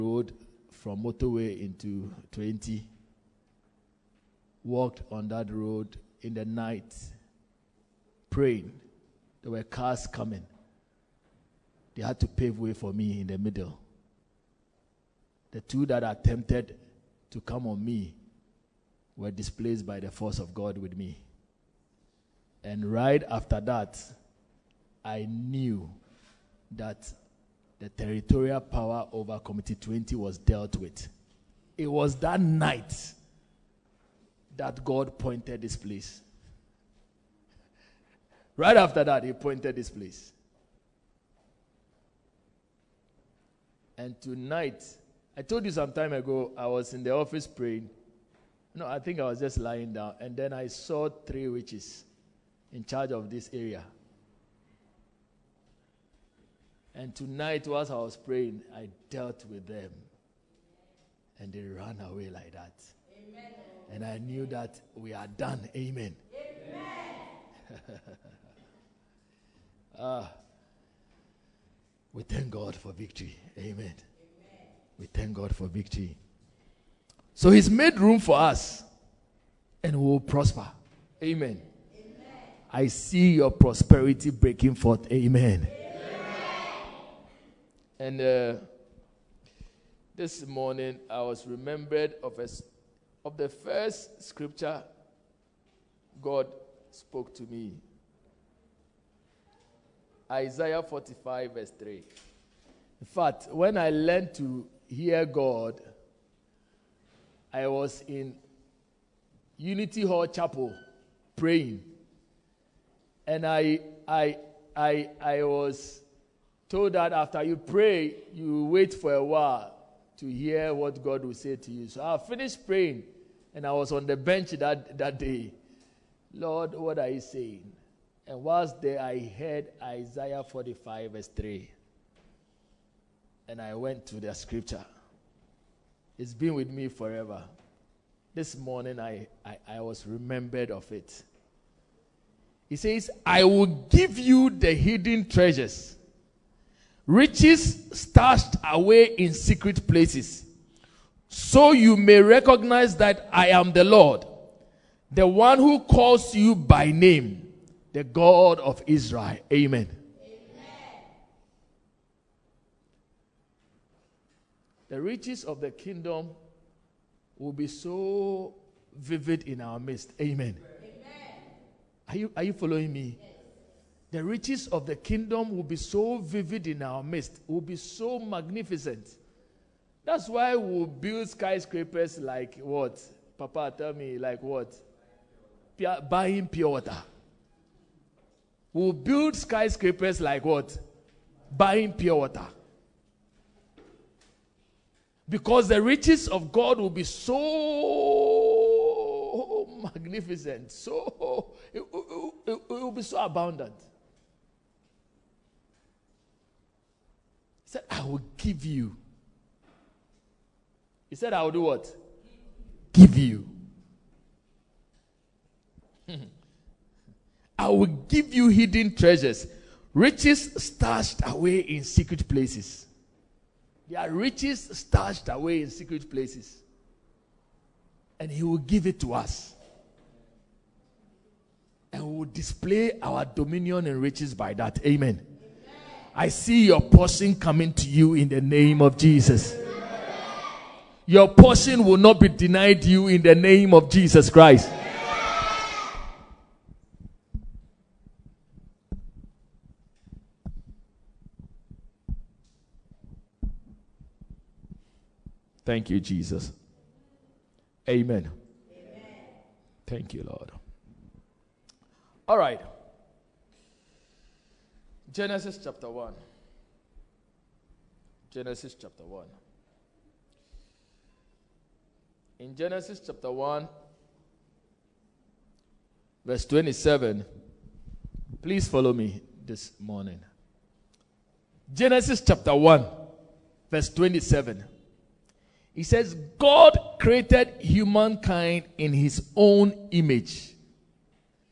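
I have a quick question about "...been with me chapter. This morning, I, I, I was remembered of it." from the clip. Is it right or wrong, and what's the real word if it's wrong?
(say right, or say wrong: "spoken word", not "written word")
wrong: "forever", not "chapter".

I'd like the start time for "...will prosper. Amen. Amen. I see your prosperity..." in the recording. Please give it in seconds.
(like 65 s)
80 s.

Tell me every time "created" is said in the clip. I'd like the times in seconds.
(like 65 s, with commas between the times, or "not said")
286 s.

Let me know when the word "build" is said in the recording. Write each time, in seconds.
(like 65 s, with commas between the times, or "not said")
180 s, 188 s.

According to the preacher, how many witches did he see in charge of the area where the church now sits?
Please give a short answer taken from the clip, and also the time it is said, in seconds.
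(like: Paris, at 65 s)
3, at 51 s.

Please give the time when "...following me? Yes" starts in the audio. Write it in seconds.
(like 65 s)
172 s.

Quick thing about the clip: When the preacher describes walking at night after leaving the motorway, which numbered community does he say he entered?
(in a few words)
Community 20.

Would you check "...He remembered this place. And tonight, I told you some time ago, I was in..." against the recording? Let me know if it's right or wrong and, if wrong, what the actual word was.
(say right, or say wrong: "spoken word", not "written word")
wrong: "pointed", not "remembered".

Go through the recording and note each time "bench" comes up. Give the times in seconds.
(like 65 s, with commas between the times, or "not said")
124 s.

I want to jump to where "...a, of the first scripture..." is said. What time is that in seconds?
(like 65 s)
92 s.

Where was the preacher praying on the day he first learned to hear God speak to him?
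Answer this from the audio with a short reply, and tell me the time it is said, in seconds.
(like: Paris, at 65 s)
Unity Hall Chapel, at 109 s.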